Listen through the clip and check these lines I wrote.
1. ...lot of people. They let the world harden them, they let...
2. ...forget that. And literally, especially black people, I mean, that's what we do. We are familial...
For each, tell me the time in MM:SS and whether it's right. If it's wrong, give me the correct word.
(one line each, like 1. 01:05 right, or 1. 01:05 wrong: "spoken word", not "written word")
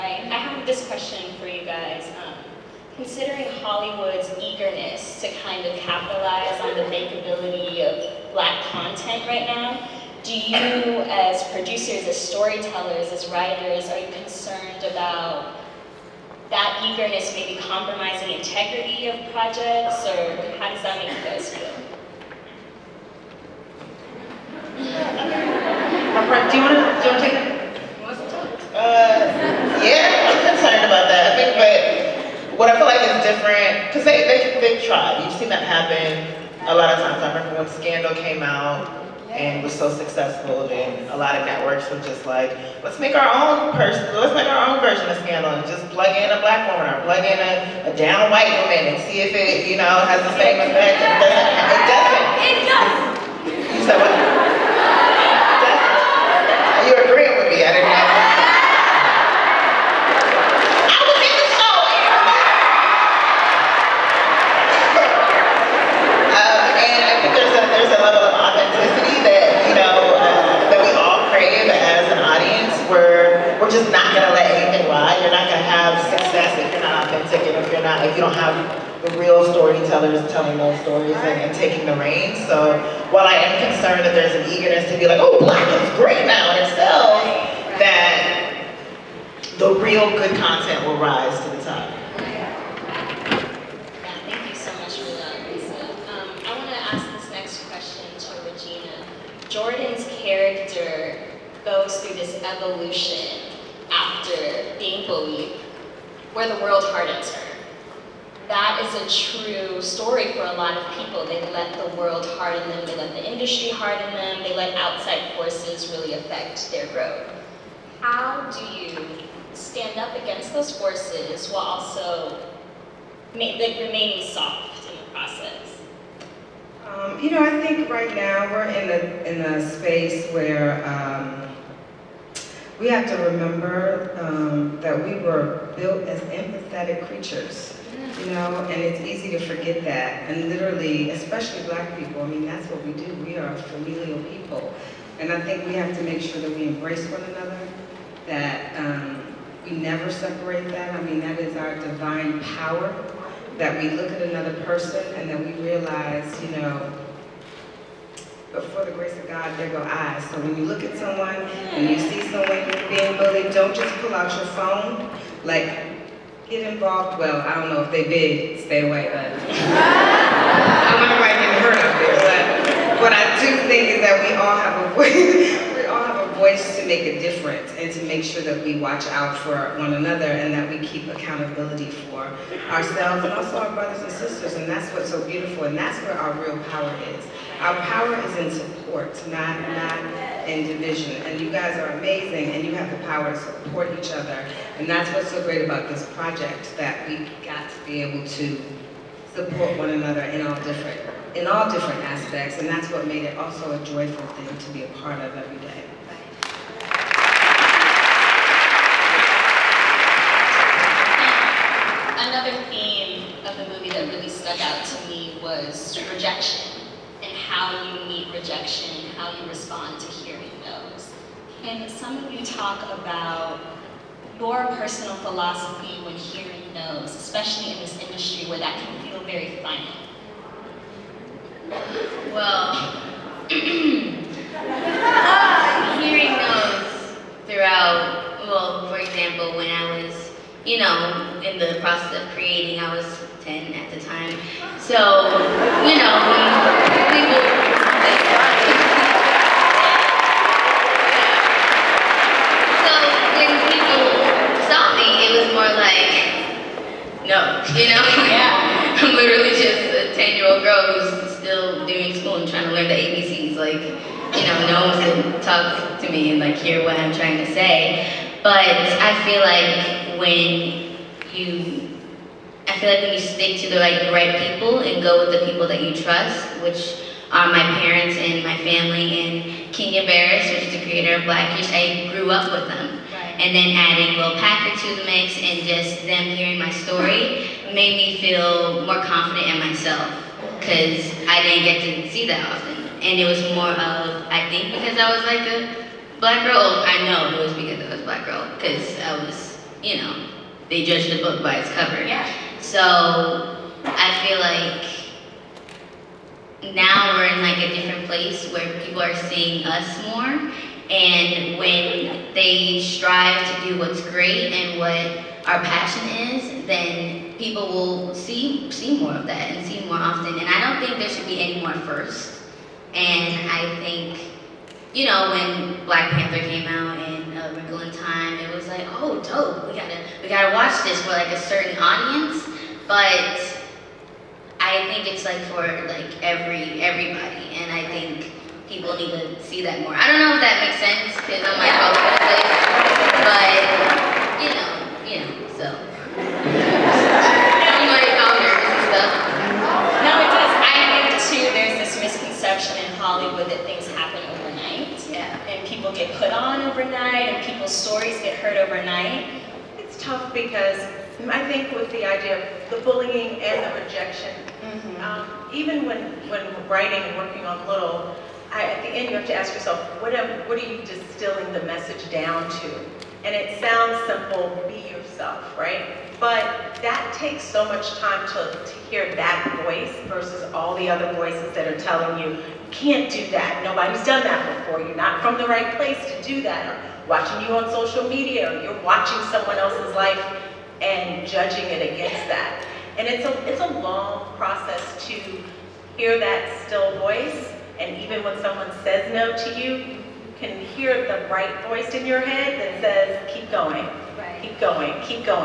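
1. 01:50 right
2. 02:19 right.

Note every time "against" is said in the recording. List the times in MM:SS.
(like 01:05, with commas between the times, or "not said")
02:00, 06:31.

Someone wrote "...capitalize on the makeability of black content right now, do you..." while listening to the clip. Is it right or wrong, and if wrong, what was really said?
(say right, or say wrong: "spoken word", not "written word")
right.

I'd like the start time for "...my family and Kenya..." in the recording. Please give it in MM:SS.
04:38.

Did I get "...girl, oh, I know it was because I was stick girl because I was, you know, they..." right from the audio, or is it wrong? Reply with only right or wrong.
wrong.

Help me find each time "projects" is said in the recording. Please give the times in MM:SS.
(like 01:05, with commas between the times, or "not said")
00:19, 03:16.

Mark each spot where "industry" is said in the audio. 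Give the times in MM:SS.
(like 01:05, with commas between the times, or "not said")
01:53, 03:48.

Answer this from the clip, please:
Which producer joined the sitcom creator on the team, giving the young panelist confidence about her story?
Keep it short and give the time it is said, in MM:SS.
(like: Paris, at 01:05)
Will Packer, at 04:44.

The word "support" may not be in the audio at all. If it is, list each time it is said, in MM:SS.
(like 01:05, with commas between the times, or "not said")
03:08, 03:13, 03:19.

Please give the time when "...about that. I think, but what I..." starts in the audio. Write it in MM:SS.
00:30.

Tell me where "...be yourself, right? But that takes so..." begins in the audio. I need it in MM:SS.
06:14.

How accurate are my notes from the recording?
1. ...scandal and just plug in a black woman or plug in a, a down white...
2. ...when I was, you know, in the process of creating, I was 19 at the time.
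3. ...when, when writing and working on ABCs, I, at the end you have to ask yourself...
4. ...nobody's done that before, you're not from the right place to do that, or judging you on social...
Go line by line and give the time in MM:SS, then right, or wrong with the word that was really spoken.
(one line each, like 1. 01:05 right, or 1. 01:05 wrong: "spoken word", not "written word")
1. 00:45 right
2. 03:59 wrong: "10", not "19"
3. 06:05 wrong: "Little", not "ABCs"
4. 06:23 wrong: "watching", not "judging".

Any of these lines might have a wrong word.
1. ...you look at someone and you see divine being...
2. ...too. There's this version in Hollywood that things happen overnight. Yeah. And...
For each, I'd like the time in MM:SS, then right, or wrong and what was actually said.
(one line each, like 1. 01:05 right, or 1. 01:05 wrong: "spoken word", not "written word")
1. 02:40 wrong: "someone", not "divine"
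2. 05:51 wrong: "misconception", not "version".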